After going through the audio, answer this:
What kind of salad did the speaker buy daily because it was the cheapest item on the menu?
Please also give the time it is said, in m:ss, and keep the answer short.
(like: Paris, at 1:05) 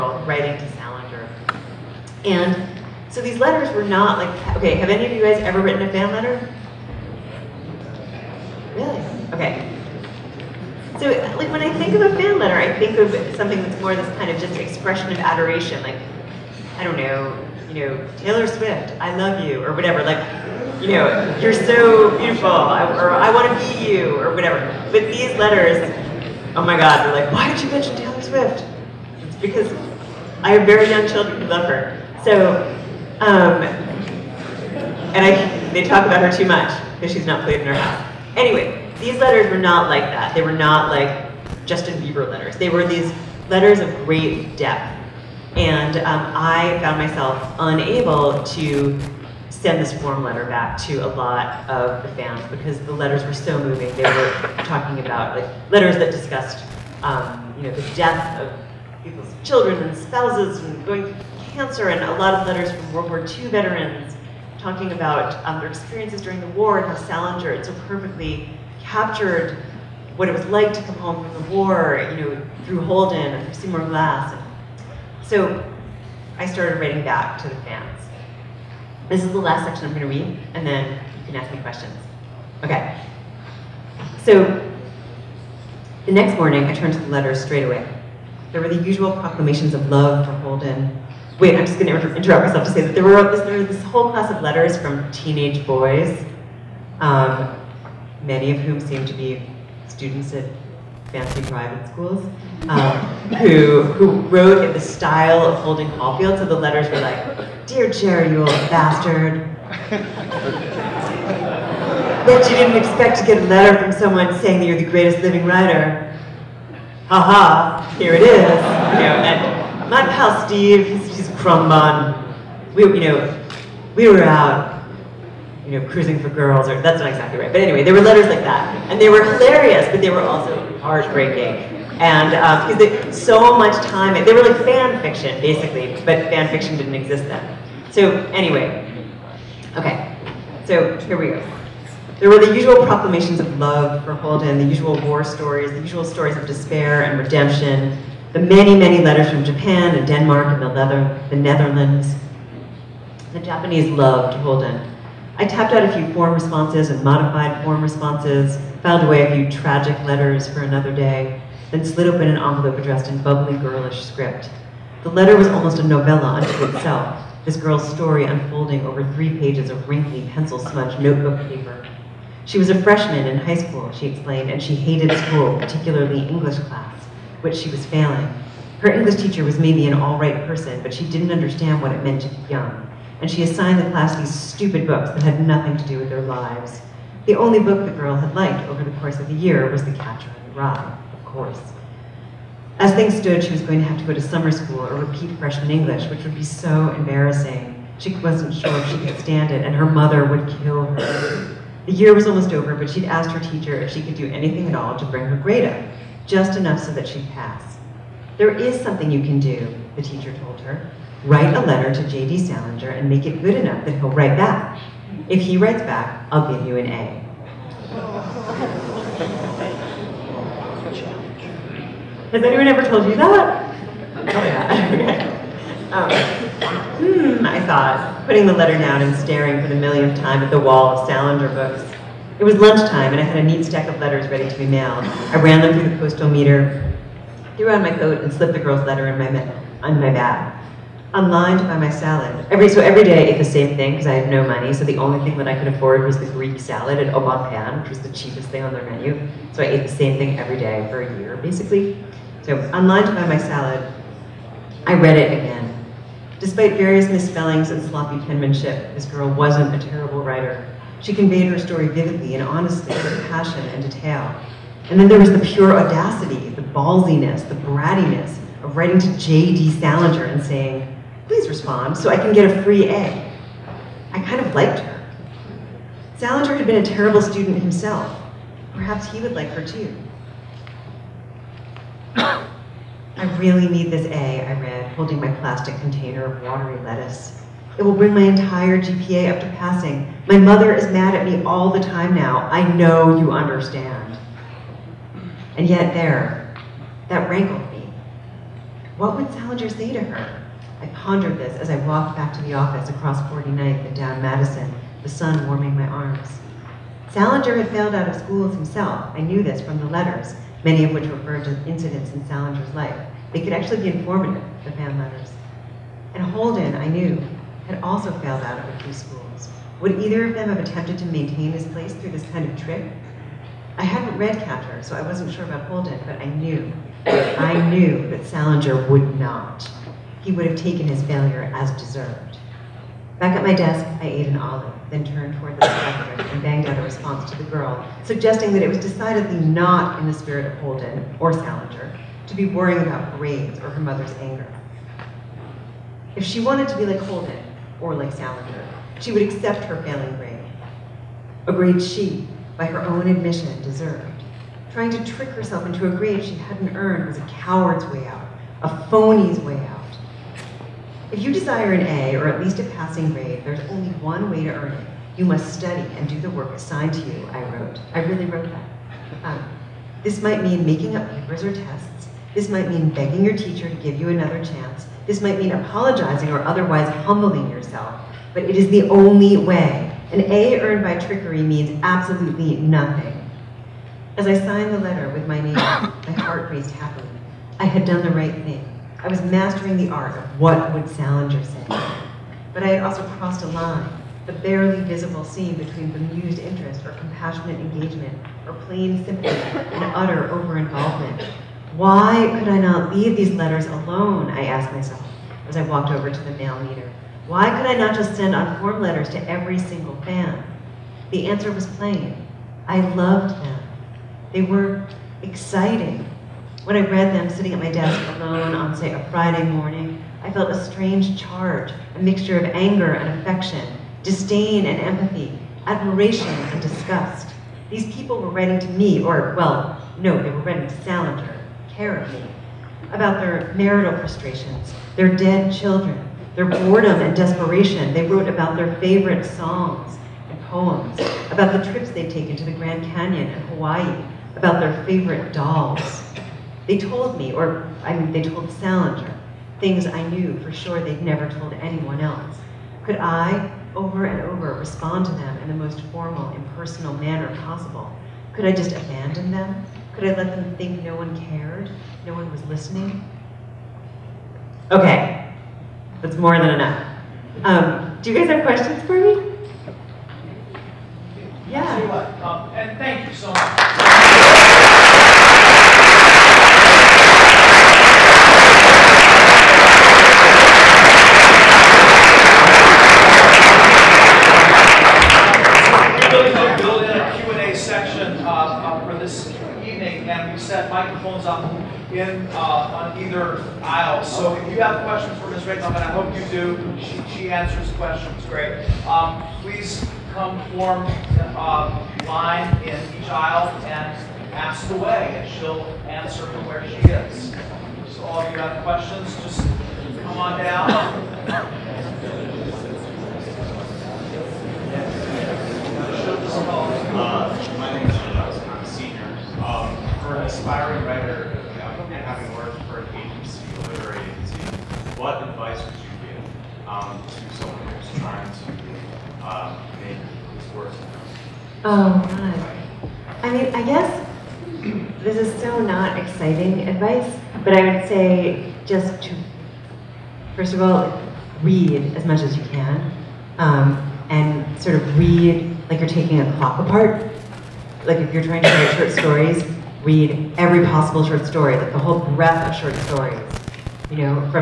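Greek salad, at 4:06.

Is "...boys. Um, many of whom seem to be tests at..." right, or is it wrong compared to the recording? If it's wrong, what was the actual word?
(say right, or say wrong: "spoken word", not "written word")
wrong: "students", not "tests".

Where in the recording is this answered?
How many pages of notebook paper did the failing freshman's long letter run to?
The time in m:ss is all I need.
2:49.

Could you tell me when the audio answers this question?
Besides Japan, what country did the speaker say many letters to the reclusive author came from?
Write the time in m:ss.
2:30.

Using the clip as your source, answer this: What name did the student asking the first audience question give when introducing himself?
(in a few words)
Alex.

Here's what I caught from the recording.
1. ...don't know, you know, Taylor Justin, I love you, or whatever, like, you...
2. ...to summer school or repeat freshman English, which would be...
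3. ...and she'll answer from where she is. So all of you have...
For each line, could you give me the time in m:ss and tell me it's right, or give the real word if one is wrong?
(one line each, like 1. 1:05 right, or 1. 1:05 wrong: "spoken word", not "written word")
1. 0:16 wrong: "Swift", not "Justin"
2. 3:14 right
3. 8:25 right.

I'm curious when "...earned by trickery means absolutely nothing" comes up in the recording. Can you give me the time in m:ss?
6:20.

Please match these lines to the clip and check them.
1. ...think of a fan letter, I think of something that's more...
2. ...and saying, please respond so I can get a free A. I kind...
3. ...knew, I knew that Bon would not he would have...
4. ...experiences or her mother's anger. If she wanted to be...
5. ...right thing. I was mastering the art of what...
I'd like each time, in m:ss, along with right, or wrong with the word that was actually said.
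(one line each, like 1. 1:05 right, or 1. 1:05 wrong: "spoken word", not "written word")
1. 0:11 right
2. 4:30 right
3. 5:26 wrong: "Salinger", not "Bon"
4. 5:43 wrong: "grades", not "experiences"
5. 6:28 right.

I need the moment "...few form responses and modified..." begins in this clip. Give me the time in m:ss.
2:35.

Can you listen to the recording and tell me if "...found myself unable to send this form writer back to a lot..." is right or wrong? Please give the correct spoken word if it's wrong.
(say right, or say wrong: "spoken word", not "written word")
wrong: "letter", not "writer".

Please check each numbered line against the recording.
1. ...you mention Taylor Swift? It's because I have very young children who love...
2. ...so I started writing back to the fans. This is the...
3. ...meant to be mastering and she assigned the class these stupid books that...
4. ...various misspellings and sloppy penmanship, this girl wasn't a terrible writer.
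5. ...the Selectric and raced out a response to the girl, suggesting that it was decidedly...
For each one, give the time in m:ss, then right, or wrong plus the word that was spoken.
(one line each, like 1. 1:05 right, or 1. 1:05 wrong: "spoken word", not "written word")
1. 0:27 right
2. 1:15 right
3. 3:02 wrong: "young", not "mastering"
4. 4:16 right
5. 5:35 wrong: "banged", not "raced".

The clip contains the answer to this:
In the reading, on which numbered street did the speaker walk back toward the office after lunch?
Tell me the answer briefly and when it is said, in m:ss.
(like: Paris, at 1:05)
49th, at 5:03.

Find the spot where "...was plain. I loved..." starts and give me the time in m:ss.
6:51.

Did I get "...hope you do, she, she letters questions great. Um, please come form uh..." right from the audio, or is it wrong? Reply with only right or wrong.
wrong.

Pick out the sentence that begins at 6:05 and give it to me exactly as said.
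You must study and do the work assigned to you, I wrote.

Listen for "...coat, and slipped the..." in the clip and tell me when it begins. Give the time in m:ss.
3:57.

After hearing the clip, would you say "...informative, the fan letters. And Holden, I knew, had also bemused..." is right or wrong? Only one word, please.
wrong.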